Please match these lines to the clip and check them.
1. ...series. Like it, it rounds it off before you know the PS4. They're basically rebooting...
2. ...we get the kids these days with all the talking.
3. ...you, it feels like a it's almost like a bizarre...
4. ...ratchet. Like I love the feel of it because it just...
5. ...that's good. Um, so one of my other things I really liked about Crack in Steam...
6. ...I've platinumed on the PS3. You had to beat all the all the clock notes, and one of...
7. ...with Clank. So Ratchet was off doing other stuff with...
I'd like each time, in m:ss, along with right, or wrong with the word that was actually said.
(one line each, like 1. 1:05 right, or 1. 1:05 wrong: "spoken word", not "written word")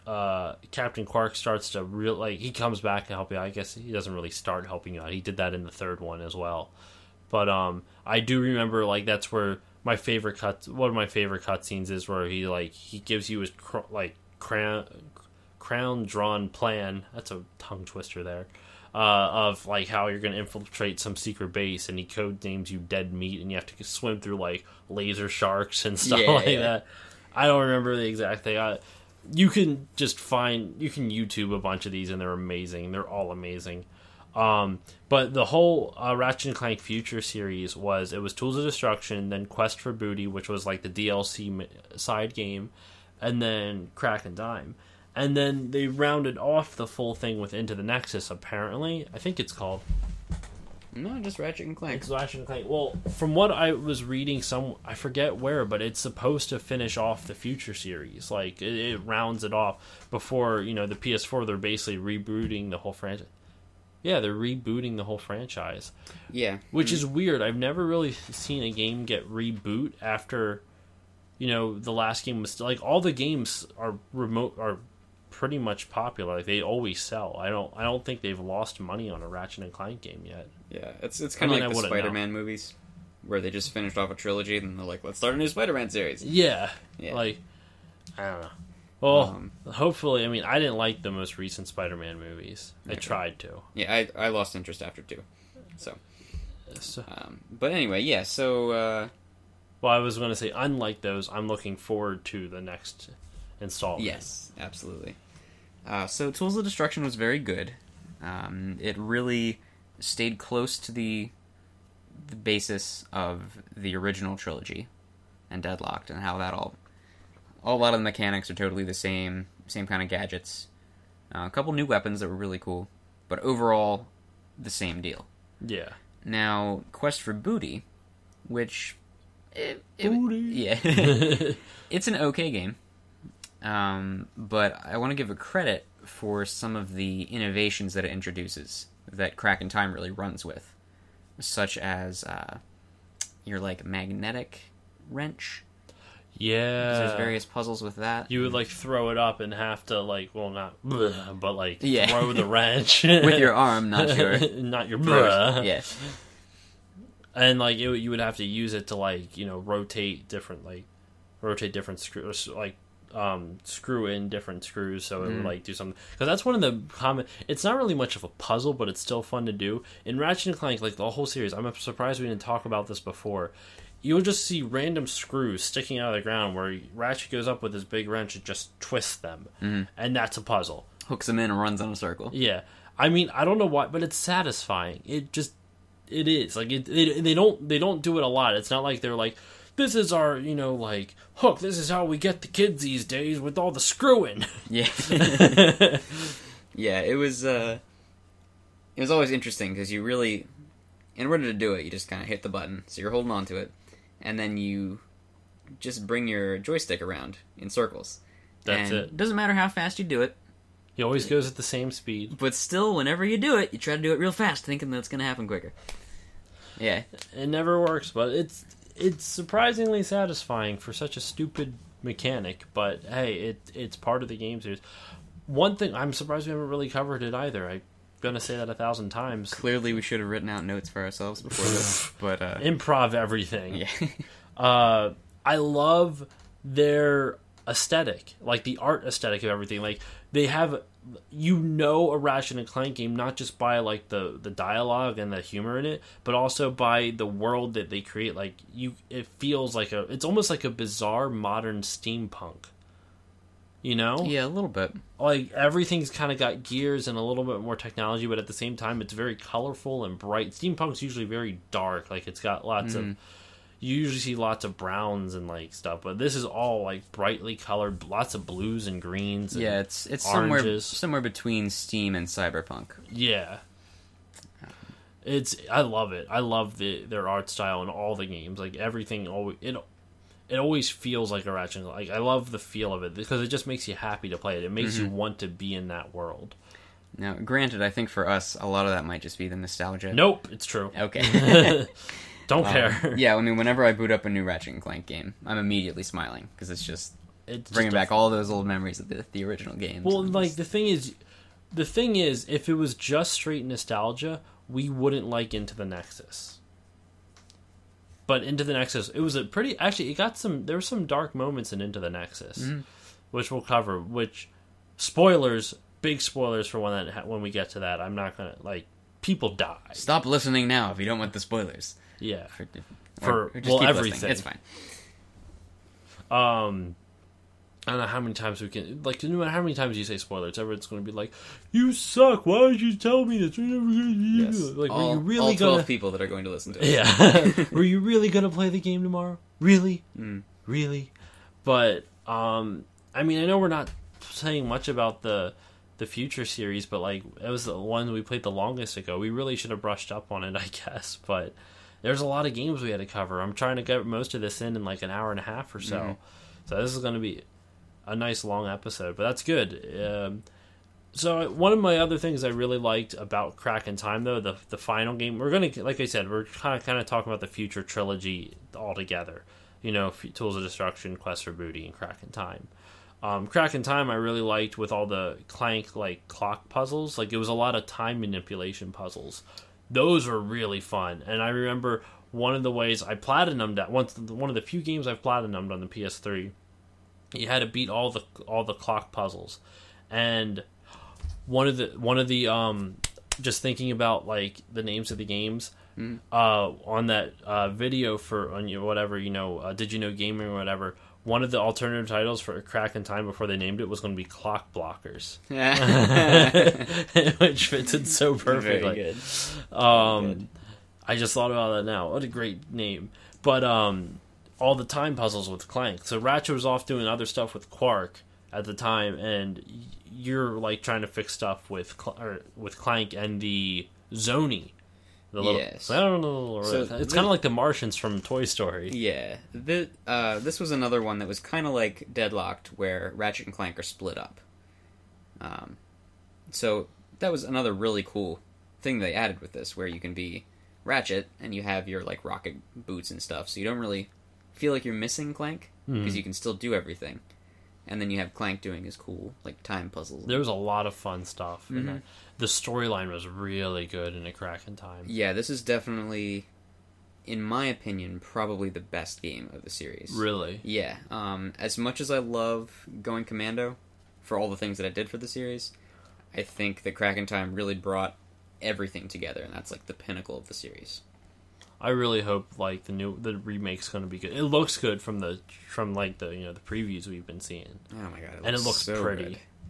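1. 0:57 right
2. 3:12 wrong: "screwing", not "talking"
3. 4:08 right
4. 4:41 right
5. 5:59 wrong: "Time", not "Steam"
6. 6:25 wrong: "puzzles", not "notes"
7. 6:55 right.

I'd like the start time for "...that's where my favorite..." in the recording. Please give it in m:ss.
0:09.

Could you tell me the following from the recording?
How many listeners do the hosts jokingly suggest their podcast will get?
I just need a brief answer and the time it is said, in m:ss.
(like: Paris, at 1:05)
12, at 5:35.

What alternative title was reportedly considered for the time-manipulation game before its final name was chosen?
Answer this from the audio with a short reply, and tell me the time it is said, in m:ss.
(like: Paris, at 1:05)
Clock Blockers, at 6:44.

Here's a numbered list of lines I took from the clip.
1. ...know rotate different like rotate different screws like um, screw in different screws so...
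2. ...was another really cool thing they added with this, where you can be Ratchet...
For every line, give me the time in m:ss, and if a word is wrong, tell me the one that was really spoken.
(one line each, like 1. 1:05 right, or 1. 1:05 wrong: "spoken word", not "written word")
1. 2:39 right
2. 7:17 right.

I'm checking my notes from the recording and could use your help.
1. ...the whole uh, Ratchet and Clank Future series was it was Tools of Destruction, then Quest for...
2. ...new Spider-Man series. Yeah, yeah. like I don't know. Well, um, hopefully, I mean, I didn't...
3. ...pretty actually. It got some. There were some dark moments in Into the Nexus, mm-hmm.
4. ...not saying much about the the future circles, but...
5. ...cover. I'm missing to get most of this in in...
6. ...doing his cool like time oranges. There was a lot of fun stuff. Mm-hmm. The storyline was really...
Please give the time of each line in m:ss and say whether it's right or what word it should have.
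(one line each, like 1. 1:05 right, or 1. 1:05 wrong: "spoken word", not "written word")
1. 0:35 right
2. 1:25 right
3. 5:09 right
4. 5:43 wrong: "series", not "circles"
5. 5:53 wrong: "trying", not "missing"
6. 7:28 wrong: "puzzles", not "oranges".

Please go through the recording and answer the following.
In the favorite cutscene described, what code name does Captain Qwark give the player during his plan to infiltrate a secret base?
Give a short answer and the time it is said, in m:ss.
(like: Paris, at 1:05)
Dead Meat, at 0:22.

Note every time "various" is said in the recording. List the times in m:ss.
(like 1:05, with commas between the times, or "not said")
2:27.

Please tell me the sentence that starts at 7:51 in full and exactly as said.
I really hope like the new the remake's going to be good.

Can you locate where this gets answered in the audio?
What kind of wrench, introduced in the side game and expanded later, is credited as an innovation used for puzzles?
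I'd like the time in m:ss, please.
2:23.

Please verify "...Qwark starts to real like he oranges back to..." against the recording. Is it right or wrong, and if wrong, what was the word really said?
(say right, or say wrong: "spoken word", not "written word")
wrong: "comes", not "oranges".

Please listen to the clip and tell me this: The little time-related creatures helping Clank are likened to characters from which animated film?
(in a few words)
Toy Story.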